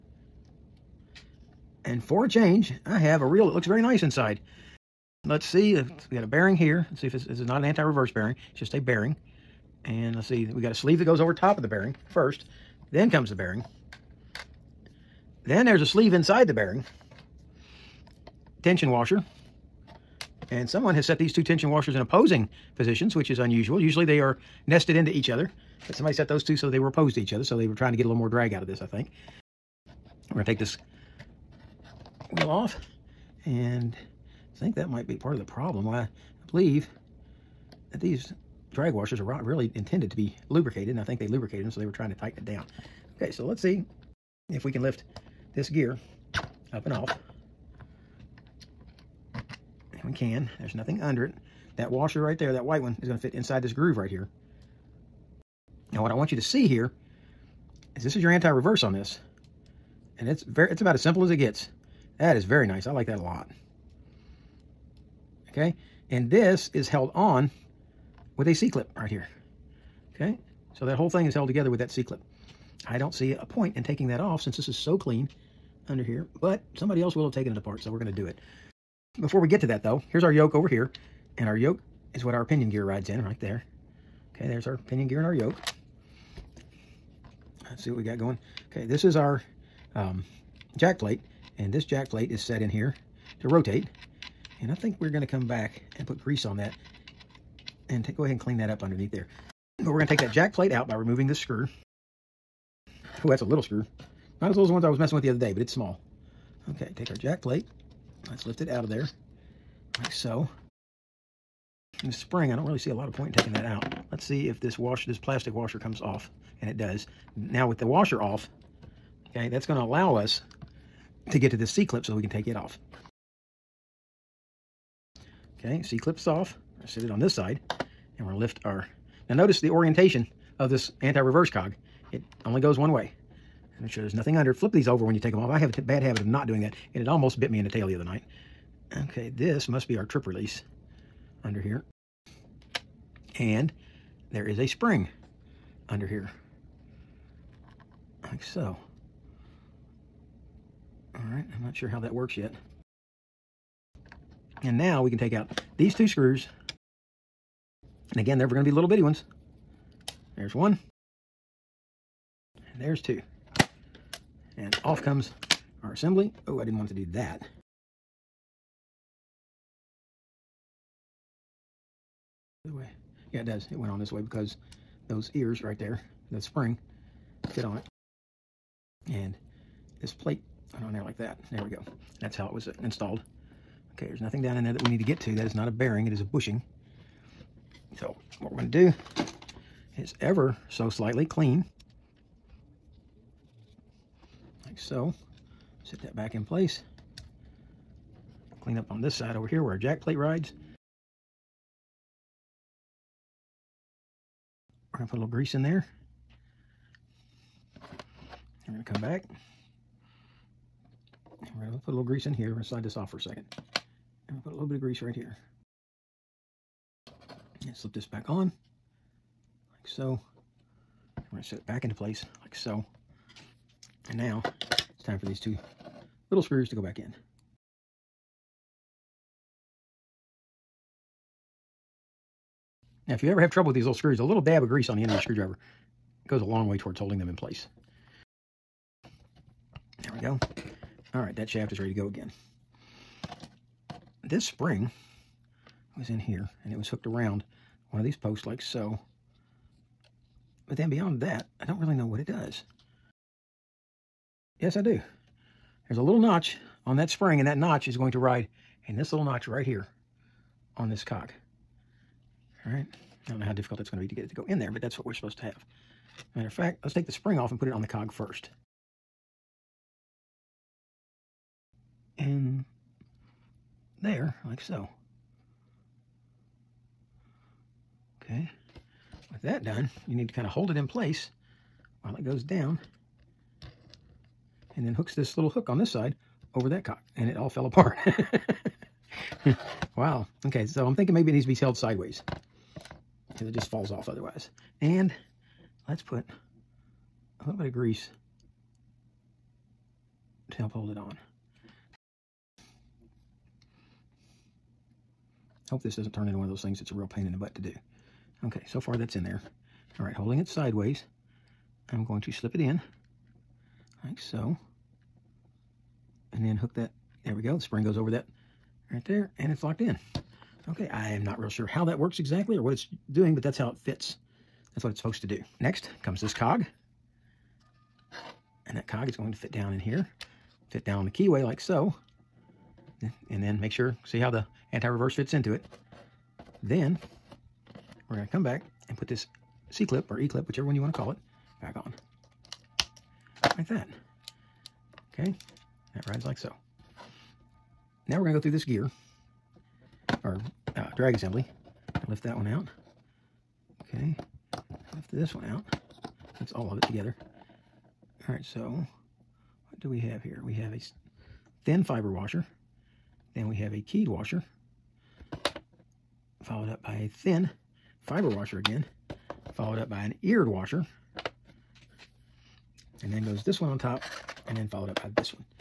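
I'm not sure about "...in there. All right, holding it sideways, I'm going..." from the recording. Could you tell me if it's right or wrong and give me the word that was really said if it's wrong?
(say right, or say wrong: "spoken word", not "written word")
right.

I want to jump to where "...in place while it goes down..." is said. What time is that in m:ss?
4:40.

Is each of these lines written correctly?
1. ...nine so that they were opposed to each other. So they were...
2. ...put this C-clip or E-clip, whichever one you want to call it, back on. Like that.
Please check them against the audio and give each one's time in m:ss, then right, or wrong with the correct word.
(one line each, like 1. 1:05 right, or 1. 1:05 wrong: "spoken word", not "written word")
1. 0:26 wrong: "two", not "nine"
2. 5:38 right.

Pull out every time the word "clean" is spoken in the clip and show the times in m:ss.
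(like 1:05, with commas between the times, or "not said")
1:14, 1:38, 3:11, 3:18.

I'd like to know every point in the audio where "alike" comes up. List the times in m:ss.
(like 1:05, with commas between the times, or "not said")
not said.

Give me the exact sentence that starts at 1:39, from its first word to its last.
But we're going to take that jack plate out by removing this screw.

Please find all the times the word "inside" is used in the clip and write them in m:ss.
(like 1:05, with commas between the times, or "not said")
0:04, 0:16, 0:53.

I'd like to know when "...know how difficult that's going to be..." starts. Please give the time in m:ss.
4:23.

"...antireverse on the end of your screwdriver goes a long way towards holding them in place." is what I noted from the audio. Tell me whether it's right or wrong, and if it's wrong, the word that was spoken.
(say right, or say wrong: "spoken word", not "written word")
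wrong: "grease", not "antireverse".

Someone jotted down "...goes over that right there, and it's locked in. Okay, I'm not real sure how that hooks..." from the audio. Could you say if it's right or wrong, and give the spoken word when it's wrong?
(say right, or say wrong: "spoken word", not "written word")
wrong: "works", not "hooks".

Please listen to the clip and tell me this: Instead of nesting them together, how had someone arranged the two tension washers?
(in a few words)
Opposing positions.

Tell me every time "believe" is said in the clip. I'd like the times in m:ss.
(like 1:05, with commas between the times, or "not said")
0:36.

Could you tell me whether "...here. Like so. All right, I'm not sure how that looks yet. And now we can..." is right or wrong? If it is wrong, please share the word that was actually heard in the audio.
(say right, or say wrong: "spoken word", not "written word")
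wrong: "works", not "looks".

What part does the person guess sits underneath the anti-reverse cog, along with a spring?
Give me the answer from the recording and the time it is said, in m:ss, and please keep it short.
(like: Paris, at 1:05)
Trip release, at 2:20.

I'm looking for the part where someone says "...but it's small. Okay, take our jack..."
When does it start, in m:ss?
1:45.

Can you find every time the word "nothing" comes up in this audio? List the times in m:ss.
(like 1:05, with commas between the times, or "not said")
0:50, 2:14, 3:04.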